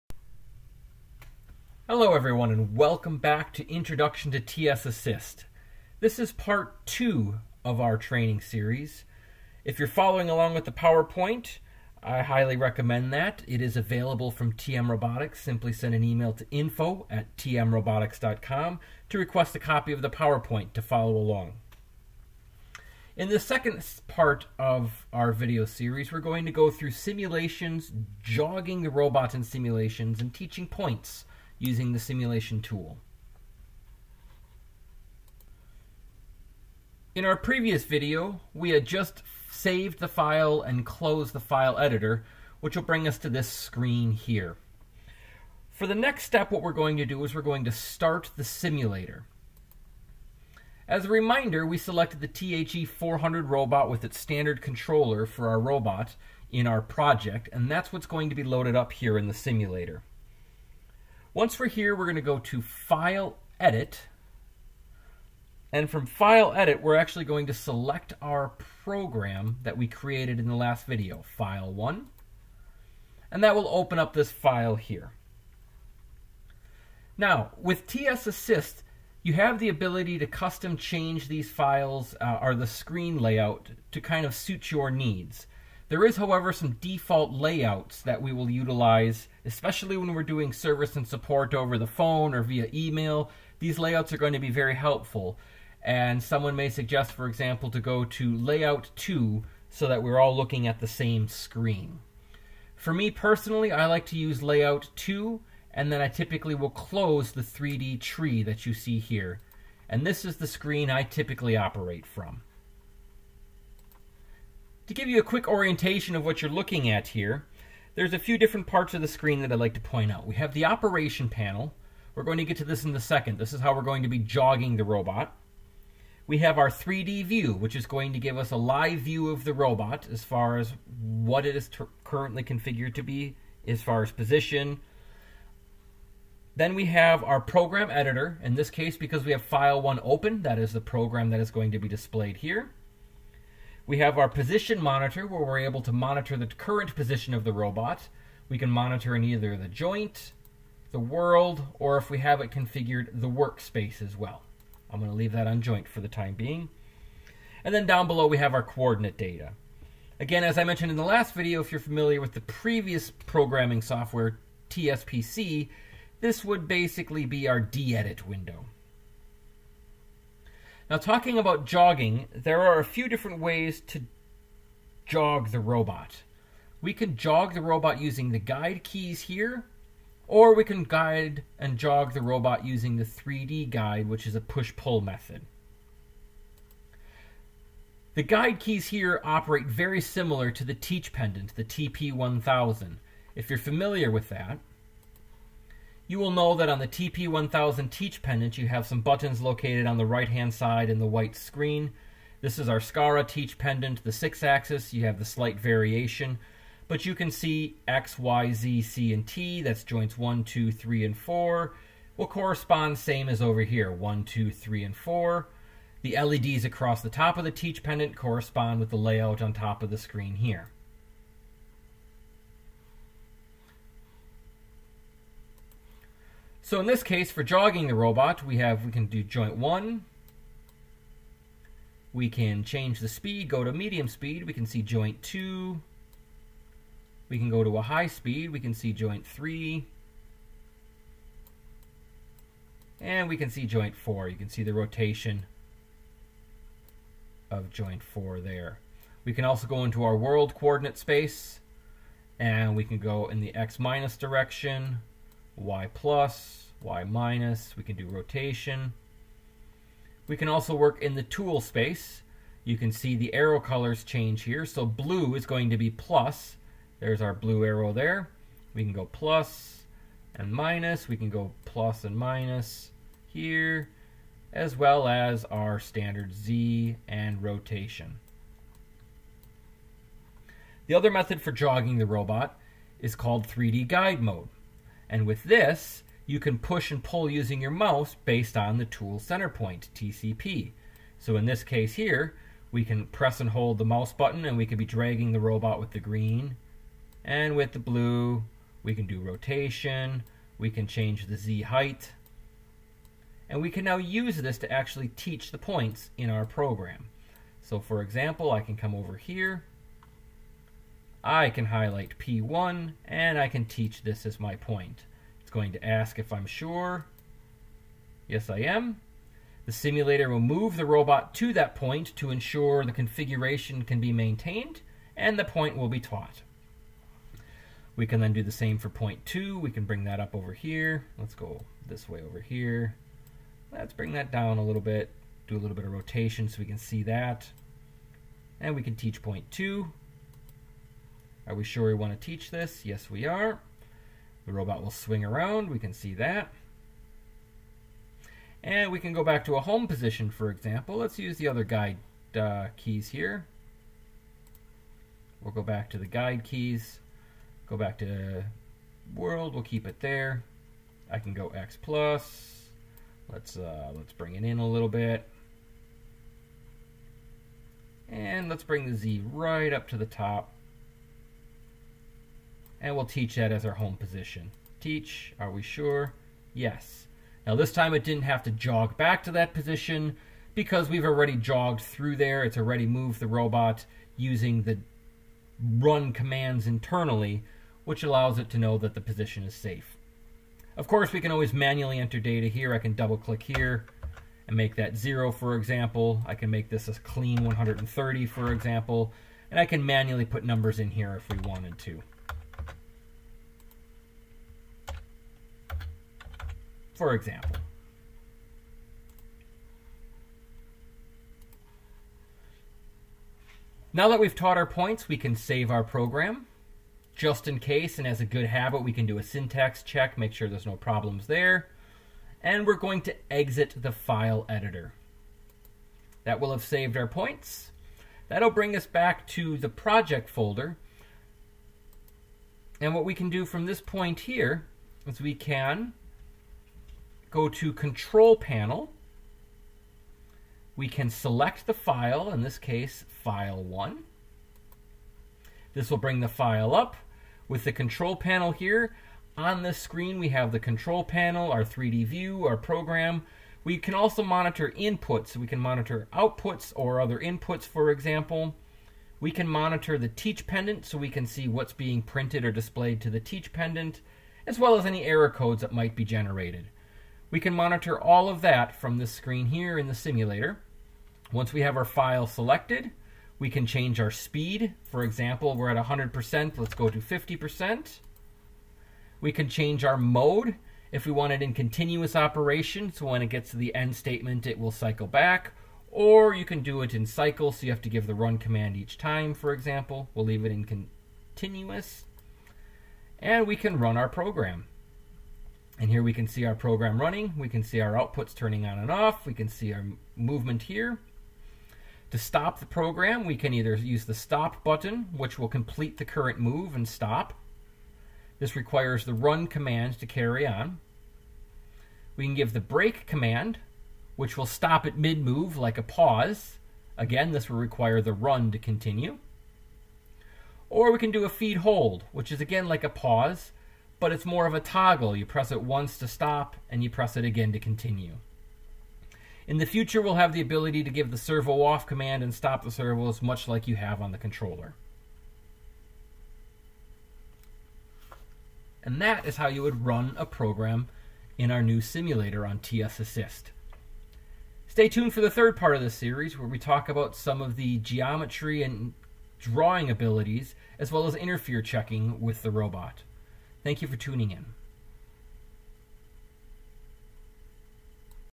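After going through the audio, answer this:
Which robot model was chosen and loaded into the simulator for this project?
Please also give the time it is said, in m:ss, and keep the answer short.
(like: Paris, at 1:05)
THE400, at 0:52.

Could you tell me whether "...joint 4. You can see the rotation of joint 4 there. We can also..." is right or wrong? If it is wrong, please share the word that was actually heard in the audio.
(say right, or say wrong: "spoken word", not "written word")
right.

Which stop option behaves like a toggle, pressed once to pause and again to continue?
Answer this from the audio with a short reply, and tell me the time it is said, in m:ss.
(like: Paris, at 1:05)
feed hold, at 8:41.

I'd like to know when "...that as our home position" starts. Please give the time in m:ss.
6:13.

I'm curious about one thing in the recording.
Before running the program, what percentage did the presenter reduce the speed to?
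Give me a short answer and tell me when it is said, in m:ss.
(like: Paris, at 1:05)
50%, at 7:56.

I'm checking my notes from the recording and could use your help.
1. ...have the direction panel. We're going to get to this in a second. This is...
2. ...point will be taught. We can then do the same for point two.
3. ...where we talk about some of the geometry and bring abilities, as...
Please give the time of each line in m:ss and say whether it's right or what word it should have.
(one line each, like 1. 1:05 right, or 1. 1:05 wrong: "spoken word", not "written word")
1. 2:00 wrong: "operation", not "direction"
2. 5:25 right
3. 9:06 wrong: "drawing", not "bring".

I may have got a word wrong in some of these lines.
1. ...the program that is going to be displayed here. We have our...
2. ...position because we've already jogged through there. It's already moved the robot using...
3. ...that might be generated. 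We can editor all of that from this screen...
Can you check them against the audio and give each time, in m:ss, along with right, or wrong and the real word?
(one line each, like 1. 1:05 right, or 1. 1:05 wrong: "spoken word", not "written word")
1. 2:20 right
2. 6:19 right
3. 7:45 wrong: "monitor", not "editor".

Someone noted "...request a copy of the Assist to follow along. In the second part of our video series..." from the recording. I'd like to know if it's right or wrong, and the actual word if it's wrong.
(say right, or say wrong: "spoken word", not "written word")
wrong: "PowerPoint", not "Assist".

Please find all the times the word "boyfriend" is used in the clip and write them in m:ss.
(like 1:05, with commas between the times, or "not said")
not said.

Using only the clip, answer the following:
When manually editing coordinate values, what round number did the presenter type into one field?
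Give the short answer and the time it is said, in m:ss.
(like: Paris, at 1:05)
130, at 6:37.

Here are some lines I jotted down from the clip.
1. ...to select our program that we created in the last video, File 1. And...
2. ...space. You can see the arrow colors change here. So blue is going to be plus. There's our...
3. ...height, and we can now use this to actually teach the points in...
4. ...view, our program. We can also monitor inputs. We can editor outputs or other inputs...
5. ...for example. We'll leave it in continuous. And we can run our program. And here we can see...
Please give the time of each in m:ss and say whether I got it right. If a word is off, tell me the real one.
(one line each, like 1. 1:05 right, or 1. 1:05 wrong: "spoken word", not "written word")
1. 1:07 right
2. 4:21 right
3. 5:01 right
4. 7:32 wrong: "monitor", not "editor"
5. 8:09 right.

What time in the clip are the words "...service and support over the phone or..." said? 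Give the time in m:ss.
1:30.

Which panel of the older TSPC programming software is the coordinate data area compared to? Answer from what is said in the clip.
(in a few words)
D-edit window.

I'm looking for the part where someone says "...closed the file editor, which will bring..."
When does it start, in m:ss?
0:40.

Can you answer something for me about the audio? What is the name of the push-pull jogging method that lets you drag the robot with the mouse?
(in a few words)
3D guide mode.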